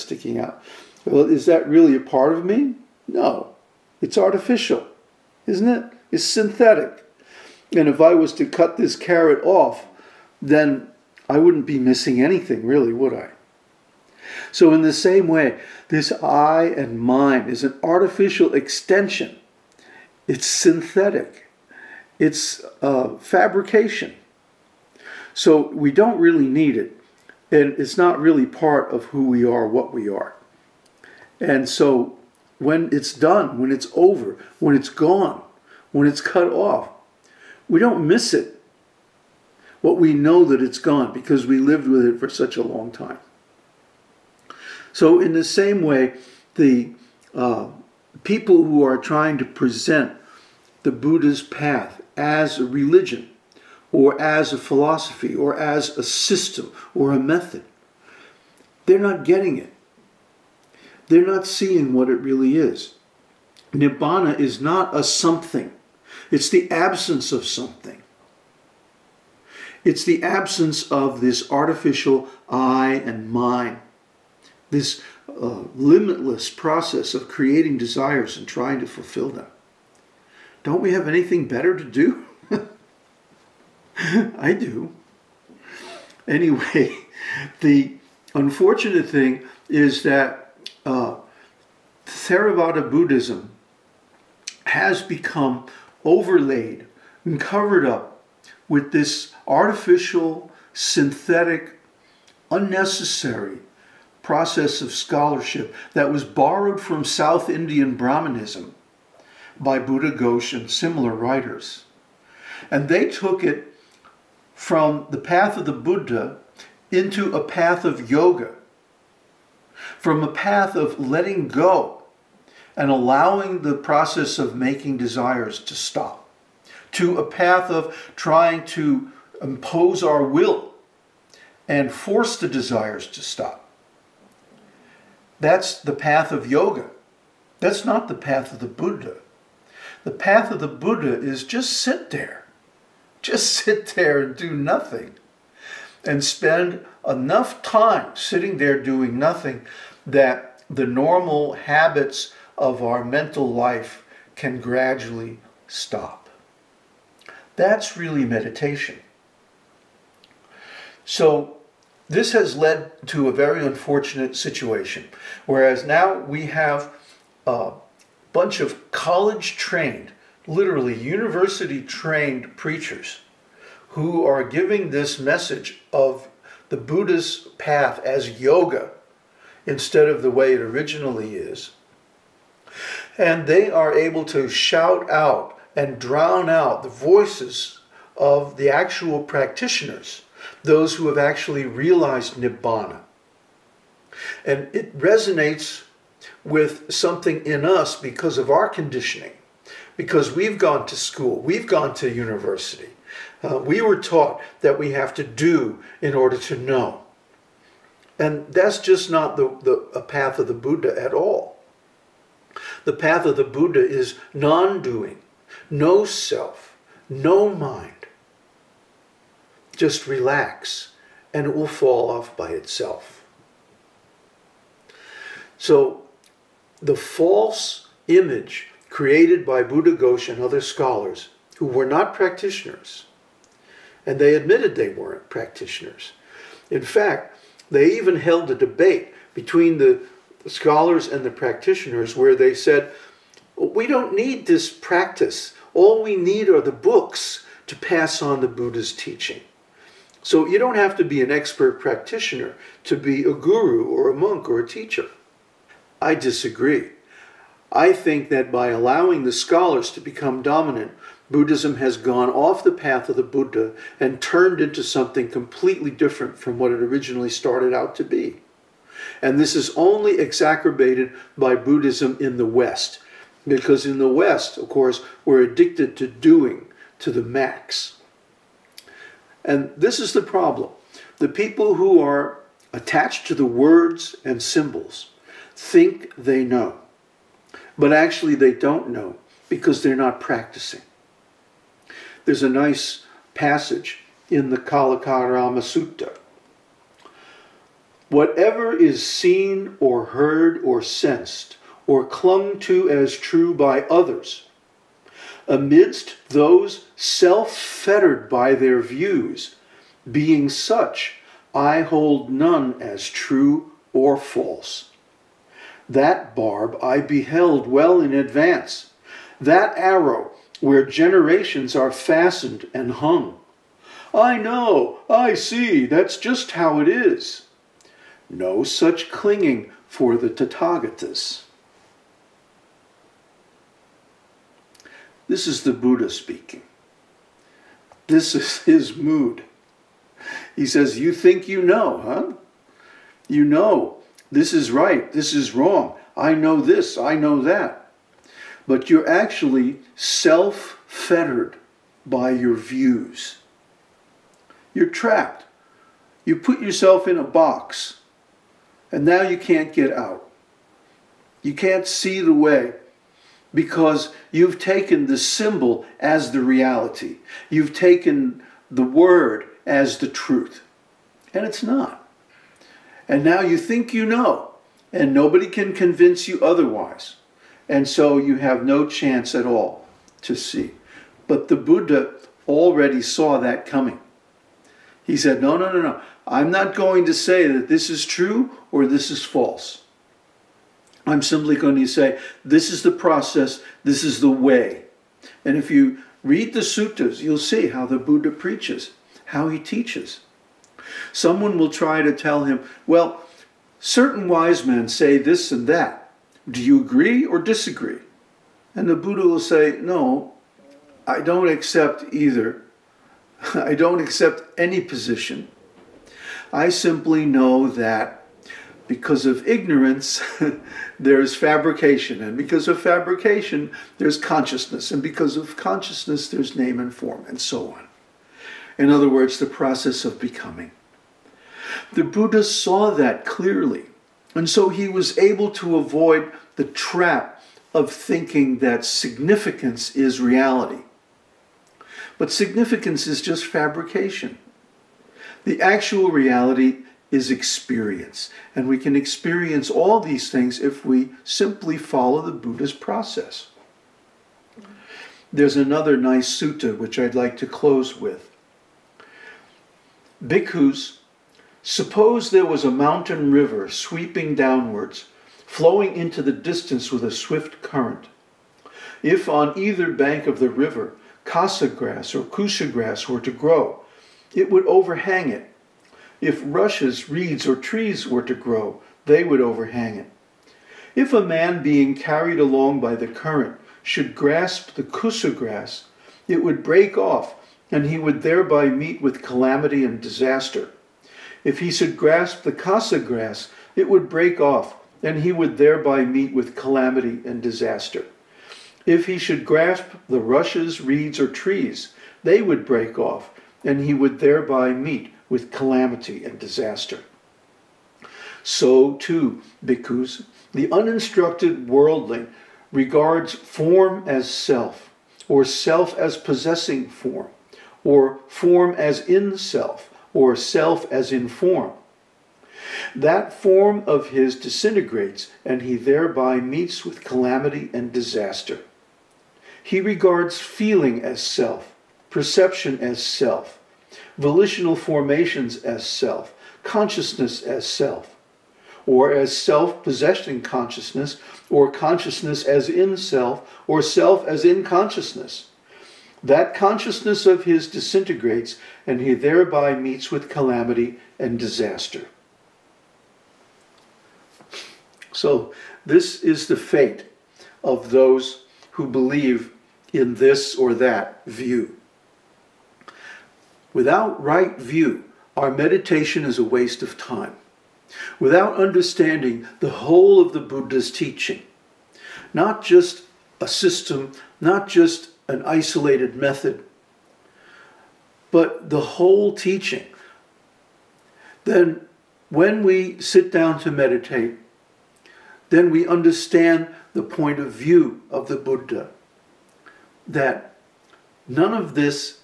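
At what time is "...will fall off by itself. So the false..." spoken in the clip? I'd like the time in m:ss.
3:41.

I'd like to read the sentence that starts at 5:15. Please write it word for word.
That barb I beheld well in advance, that arrow where generations are fastened and hung.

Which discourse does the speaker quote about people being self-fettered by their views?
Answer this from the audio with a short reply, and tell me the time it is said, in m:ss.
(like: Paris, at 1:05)
Kalakarama Sutta, at 4:54.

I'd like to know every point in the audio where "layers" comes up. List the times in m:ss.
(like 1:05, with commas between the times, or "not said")
not said.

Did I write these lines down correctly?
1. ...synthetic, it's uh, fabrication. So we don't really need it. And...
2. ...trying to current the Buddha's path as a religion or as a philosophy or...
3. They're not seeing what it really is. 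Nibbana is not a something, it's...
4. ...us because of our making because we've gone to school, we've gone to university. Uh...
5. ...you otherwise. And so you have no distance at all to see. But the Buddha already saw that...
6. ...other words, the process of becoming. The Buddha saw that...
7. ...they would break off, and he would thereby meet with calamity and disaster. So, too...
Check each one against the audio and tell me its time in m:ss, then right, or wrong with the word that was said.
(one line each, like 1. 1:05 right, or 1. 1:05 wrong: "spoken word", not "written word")
1. 0:20 right
2. 0:48 wrong: "present", not "current"
3. 1:01 right
4. 3:17 wrong: "conditioning", not "making"
5. 6:16 wrong: "chance", not "distance"
6. 7:08 right
7. 8:22 right.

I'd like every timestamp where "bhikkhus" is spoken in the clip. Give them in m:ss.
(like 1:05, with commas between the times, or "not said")
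7:40, 8:29.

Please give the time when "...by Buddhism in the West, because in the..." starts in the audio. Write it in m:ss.
4:31.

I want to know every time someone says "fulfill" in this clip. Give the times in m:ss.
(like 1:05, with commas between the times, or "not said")
1:18.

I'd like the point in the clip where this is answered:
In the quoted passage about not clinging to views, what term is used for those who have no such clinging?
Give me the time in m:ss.
5:30.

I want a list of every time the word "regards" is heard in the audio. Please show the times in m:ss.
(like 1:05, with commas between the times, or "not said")
8:32, 8:49.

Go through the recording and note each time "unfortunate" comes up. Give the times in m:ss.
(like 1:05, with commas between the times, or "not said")
1:28, 2:43.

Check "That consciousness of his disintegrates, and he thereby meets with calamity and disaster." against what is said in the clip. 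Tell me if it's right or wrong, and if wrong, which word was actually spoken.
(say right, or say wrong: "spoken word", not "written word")
right.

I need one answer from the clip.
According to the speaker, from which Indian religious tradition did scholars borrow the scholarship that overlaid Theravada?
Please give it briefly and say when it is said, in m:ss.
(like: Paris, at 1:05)
South Indian Brahmanism, at 1:47.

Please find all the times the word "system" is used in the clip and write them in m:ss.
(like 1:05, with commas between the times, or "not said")
0:56, 9:33.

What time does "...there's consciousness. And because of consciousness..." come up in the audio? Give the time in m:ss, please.
7:03.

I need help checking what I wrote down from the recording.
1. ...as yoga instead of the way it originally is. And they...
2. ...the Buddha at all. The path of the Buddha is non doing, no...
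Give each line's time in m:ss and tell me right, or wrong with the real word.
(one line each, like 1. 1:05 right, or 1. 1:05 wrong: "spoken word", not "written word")
1. 2:58 right
2. 3:30 right.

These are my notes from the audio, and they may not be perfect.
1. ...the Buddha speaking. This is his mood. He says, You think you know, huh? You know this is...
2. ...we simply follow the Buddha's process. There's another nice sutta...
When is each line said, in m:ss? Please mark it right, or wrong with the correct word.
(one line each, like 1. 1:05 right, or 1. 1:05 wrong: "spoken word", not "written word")
1. 5:35 right
2. 7:30 right.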